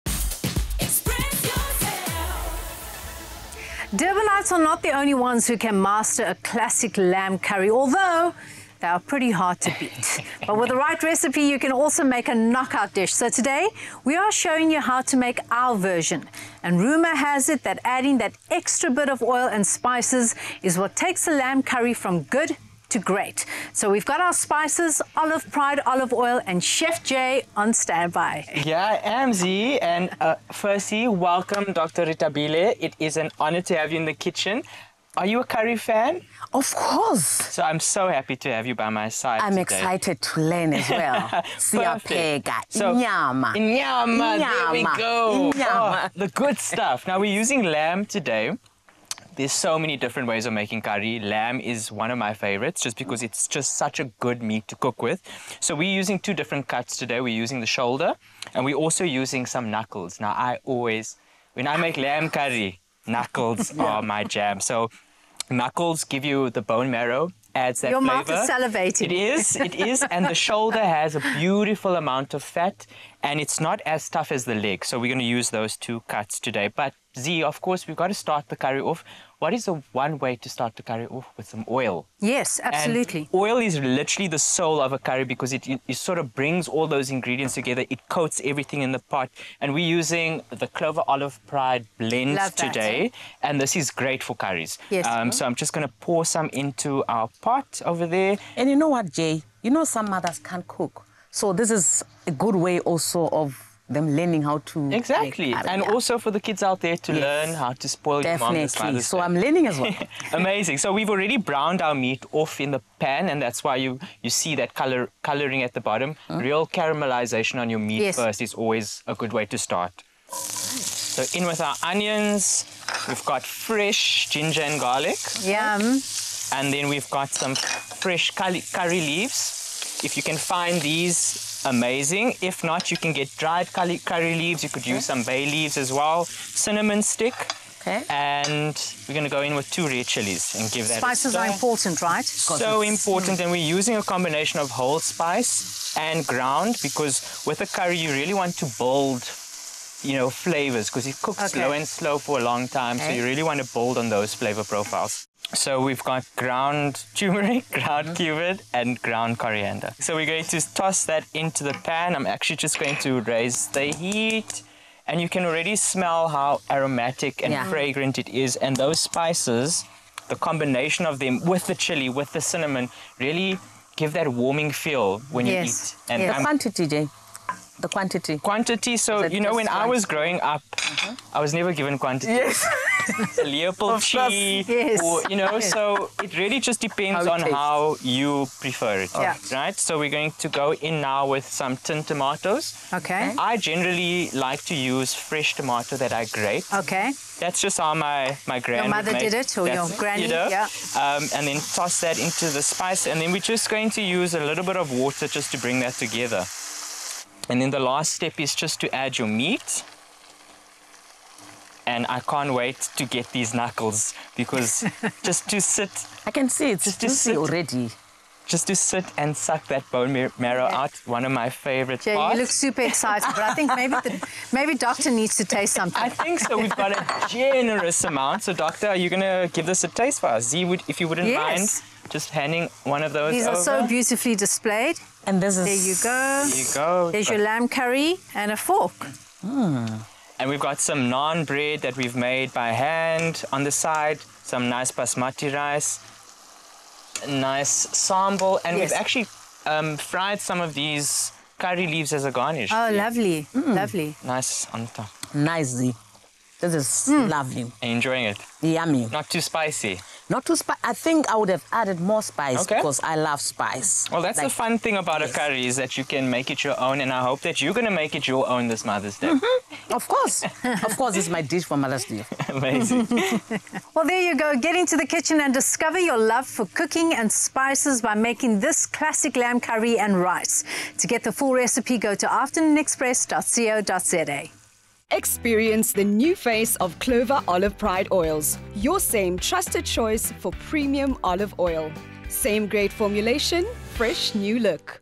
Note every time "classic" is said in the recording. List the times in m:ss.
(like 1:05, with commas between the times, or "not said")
0:06, 4:38.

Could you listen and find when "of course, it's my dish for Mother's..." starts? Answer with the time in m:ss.
4:30.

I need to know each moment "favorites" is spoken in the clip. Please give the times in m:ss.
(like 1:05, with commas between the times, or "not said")
0:52, 3:41.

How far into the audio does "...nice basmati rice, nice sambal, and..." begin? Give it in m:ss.
4:04.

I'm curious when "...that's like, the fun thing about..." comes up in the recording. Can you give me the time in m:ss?
4:24.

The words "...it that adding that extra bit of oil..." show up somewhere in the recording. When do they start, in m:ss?
0:17.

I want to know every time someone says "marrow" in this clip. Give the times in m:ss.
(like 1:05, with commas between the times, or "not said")
1:06, 3:40.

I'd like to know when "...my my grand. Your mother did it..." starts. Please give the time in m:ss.
3:17.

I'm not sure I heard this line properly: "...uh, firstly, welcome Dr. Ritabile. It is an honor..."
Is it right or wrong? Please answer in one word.
right.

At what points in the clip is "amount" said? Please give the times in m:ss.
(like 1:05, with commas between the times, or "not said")
1:11, 3:48.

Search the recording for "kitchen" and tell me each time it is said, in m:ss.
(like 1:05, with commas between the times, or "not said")
0:34, 4:35.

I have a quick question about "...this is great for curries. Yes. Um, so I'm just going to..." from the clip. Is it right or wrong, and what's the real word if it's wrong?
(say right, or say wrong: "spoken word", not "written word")
right.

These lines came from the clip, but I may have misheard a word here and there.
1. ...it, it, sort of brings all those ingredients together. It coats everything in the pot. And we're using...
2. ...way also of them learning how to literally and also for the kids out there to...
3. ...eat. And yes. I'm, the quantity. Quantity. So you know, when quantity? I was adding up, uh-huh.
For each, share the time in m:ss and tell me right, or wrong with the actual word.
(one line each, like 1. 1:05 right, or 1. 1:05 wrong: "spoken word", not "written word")
1. 1:25 right
2. 1:42 wrong: "exactly", not "literally"
3. 2:55 wrong: "growing", not "adding".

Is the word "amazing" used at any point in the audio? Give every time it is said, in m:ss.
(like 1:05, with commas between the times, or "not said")
1:50, 2:11, 4:32.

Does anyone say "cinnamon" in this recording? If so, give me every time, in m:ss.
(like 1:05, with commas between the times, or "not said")
2:16, 2:52.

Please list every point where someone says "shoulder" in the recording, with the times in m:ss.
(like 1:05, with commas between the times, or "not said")
0:57, 1:10.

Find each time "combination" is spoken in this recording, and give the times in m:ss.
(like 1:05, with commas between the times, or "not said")
2:24, 2:50.